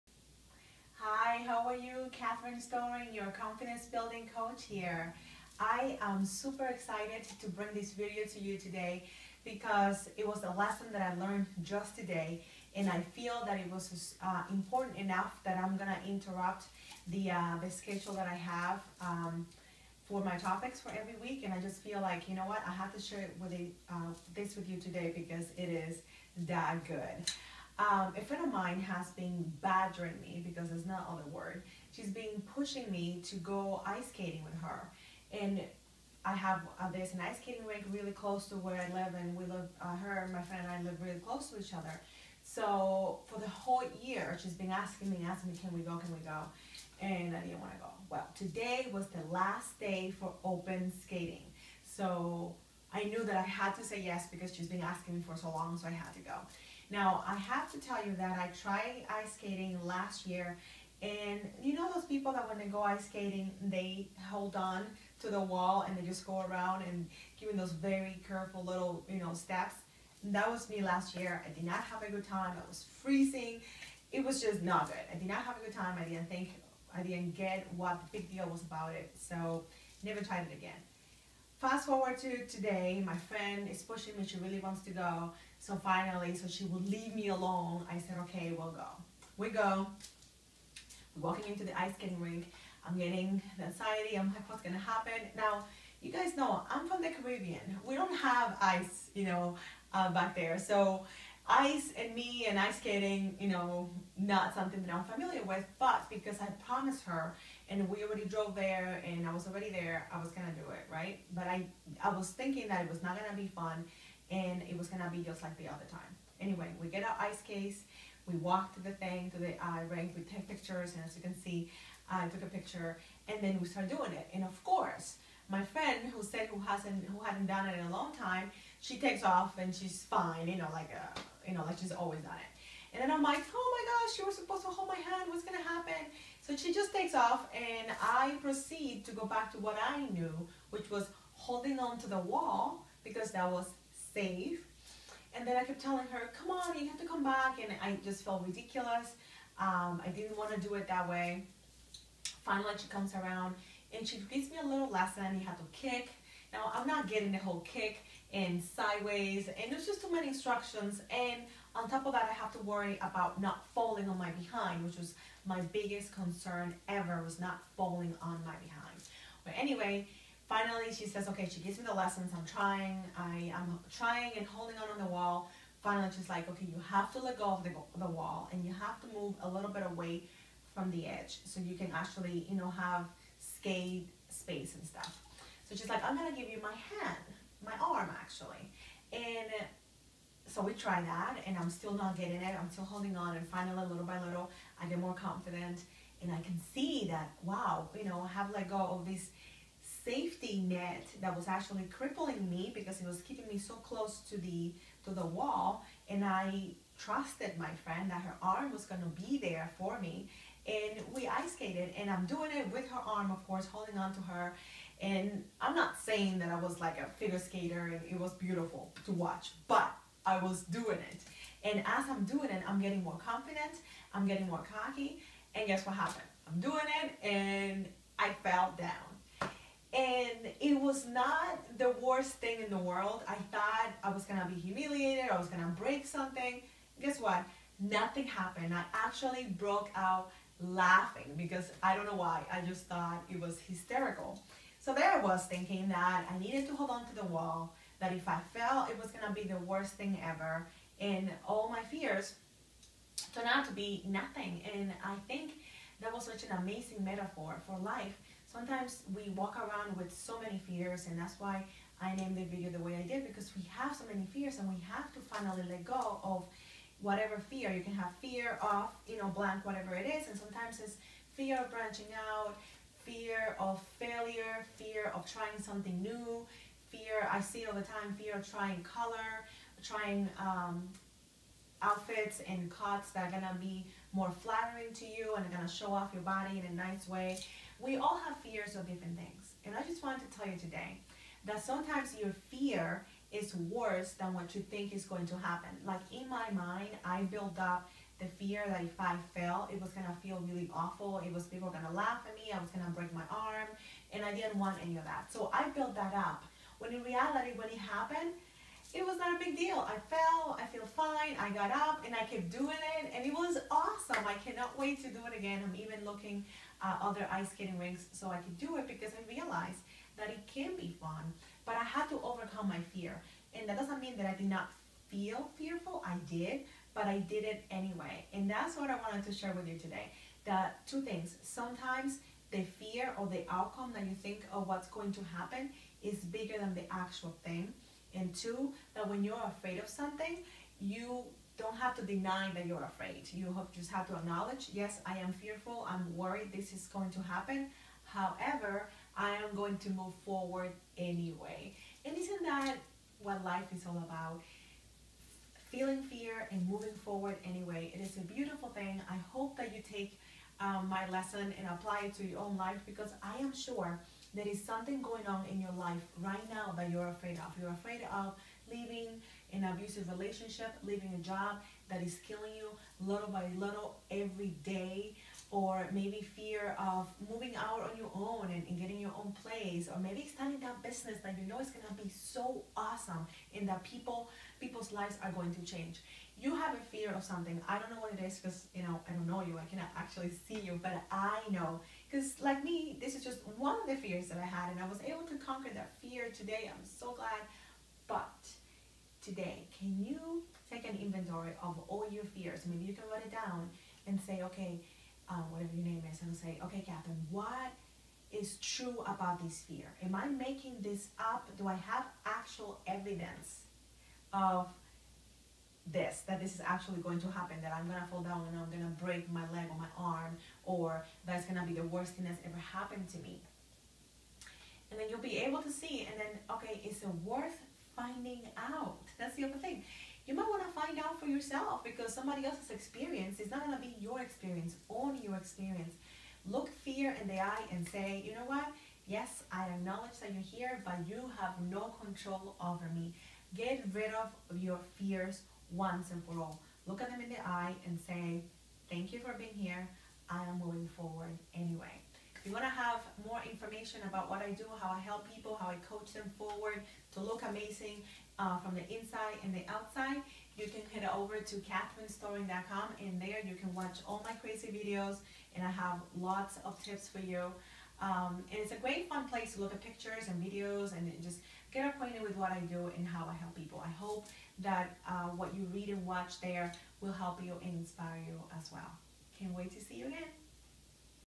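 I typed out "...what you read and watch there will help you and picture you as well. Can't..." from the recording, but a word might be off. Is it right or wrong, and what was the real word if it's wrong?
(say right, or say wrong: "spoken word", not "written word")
wrong: "inspire", not "picture".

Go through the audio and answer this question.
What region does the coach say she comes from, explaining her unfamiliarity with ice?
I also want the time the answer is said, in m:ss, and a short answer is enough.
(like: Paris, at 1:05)
The Caribbean, at 1:37.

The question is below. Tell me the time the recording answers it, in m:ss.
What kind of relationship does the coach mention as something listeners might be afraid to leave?
6:09.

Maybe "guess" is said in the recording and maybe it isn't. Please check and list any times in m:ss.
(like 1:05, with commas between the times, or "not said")
3:45, 3:57.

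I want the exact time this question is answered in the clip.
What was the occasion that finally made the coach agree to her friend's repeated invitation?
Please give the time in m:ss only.
0:49.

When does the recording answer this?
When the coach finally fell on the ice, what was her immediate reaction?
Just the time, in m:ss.
3:59.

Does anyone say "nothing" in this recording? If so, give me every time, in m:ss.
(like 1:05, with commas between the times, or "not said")
3:57, 4:14.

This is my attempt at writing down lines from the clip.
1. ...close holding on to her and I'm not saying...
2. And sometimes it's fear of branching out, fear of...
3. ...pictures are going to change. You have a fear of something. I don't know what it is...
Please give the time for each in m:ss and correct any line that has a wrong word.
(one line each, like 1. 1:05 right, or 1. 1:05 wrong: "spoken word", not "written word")
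1. 3:33 wrong: "course", not "close"
2. 4:30 right
3. 6:24 wrong: "lives", not "pictures".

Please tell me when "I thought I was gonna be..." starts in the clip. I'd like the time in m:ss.
3:53.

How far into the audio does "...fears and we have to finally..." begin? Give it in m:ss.
4:24.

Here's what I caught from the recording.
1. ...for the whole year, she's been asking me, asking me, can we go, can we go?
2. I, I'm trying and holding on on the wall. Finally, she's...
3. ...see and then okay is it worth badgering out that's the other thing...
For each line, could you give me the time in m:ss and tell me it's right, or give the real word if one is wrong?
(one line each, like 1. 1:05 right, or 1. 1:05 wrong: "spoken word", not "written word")
1. 0:43 right
2. 2:53 right
3. 7:05 wrong: "finding", not "badgering".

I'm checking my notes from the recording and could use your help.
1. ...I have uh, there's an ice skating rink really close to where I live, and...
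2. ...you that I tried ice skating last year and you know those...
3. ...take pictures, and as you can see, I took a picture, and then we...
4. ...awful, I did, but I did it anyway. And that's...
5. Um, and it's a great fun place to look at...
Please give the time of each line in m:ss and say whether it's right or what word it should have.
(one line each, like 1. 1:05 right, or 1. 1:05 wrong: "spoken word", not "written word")
1. 0:36 right
2. 0:58 right
3. 2:00 right
4. 5:25 wrong: "fearful", not "awful"
5. 7:48 right.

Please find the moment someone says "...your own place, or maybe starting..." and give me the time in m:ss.
6:19.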